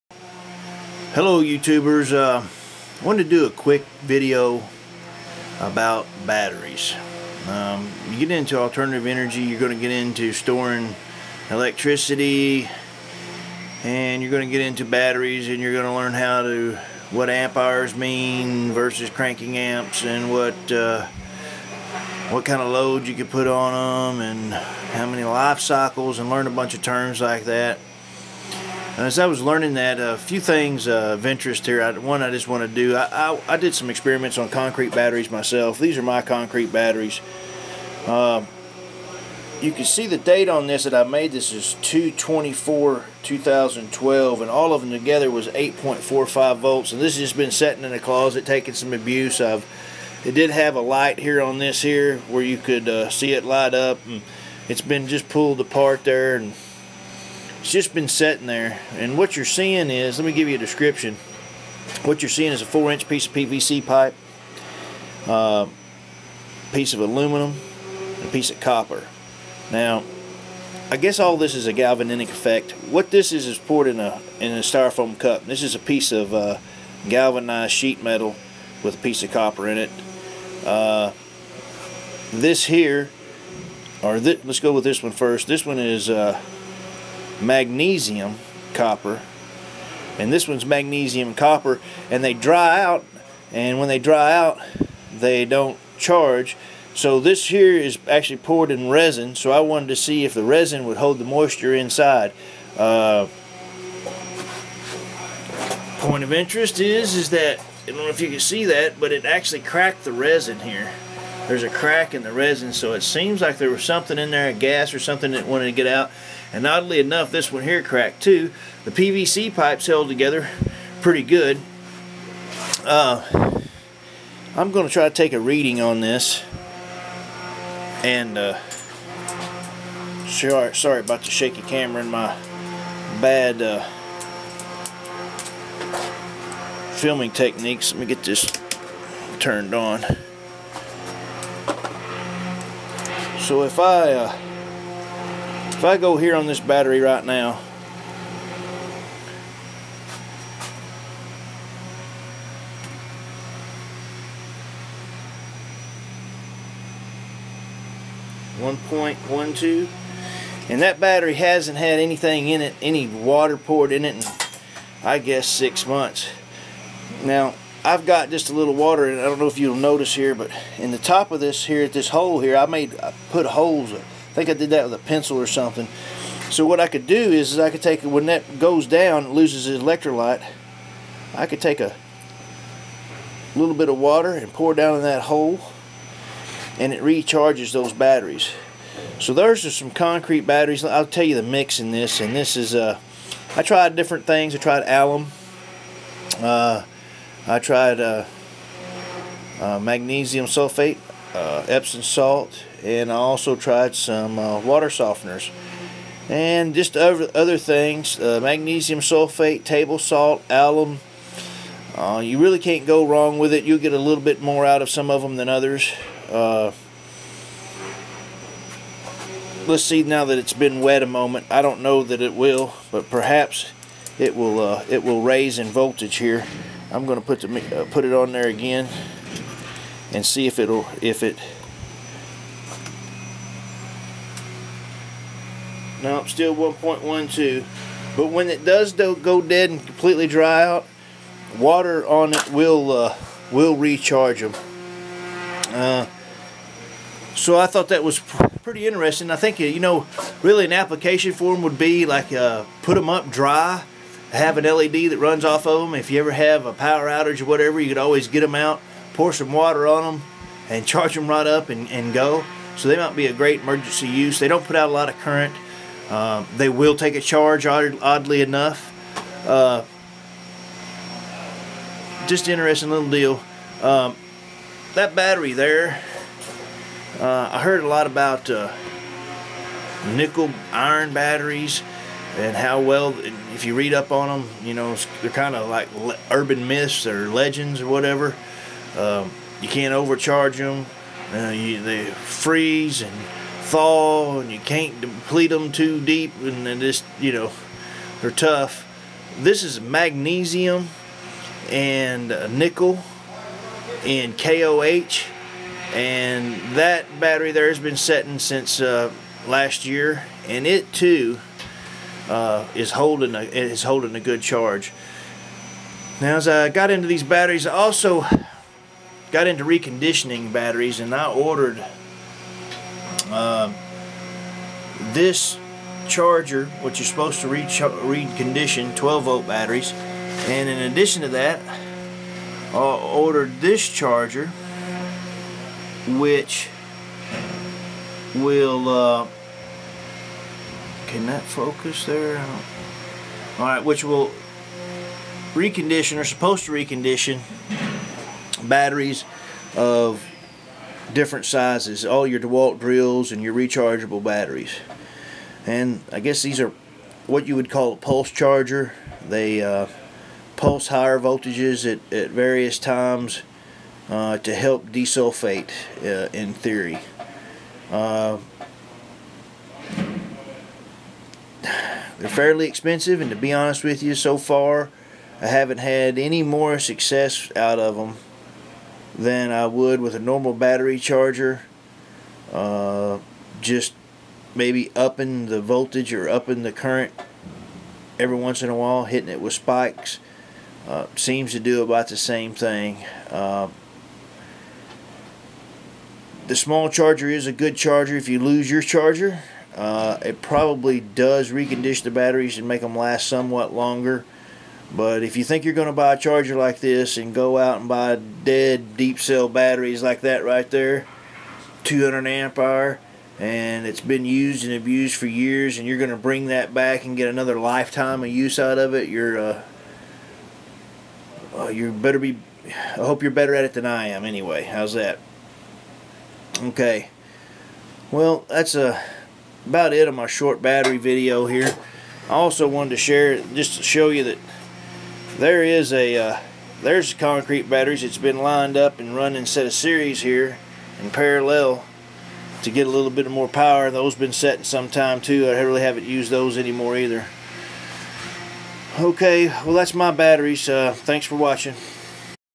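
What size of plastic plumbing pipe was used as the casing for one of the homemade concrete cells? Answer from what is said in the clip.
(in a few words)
4 inch.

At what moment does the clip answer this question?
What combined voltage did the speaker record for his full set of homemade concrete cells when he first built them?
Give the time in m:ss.
0:45.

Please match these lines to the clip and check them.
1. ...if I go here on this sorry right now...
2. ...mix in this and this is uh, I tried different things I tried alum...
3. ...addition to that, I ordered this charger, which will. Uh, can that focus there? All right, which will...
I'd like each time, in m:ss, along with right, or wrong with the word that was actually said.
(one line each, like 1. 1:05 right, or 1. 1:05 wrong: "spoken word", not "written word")
1. 2:25 wrong: "battery", not "sorry"
2. 3:11 right
3. 5:30 right.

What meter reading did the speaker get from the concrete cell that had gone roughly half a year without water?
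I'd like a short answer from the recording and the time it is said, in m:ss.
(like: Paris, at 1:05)
1.12, at 2:38.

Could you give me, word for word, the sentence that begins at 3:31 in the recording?
Uh, you really can't go wrong with it.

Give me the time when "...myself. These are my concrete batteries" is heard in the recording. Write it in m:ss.
0:35.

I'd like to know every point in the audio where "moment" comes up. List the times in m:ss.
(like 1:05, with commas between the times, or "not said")
3:41.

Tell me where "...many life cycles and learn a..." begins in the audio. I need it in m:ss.
0:25.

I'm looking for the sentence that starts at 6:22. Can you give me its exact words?
Uh, just maybe upping the voltage or upping the current every once in a while, hitting it with spikes.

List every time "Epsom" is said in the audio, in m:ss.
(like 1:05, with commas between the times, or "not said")
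3:21.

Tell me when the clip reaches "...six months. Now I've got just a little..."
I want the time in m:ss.
2:45.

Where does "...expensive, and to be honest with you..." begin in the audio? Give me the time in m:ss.
6:12.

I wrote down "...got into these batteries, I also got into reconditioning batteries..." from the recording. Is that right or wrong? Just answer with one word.
right.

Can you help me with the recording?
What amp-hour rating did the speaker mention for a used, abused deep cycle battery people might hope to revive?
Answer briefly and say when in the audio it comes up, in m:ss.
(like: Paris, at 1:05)
200 amp hours, at 6:51.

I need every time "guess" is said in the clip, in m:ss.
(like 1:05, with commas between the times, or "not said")
1:10, 2:45, 5:56.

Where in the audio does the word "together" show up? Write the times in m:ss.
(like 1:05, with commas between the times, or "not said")
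0:44, 2:00.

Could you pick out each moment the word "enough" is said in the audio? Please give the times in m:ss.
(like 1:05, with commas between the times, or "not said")
1:57, 4:28.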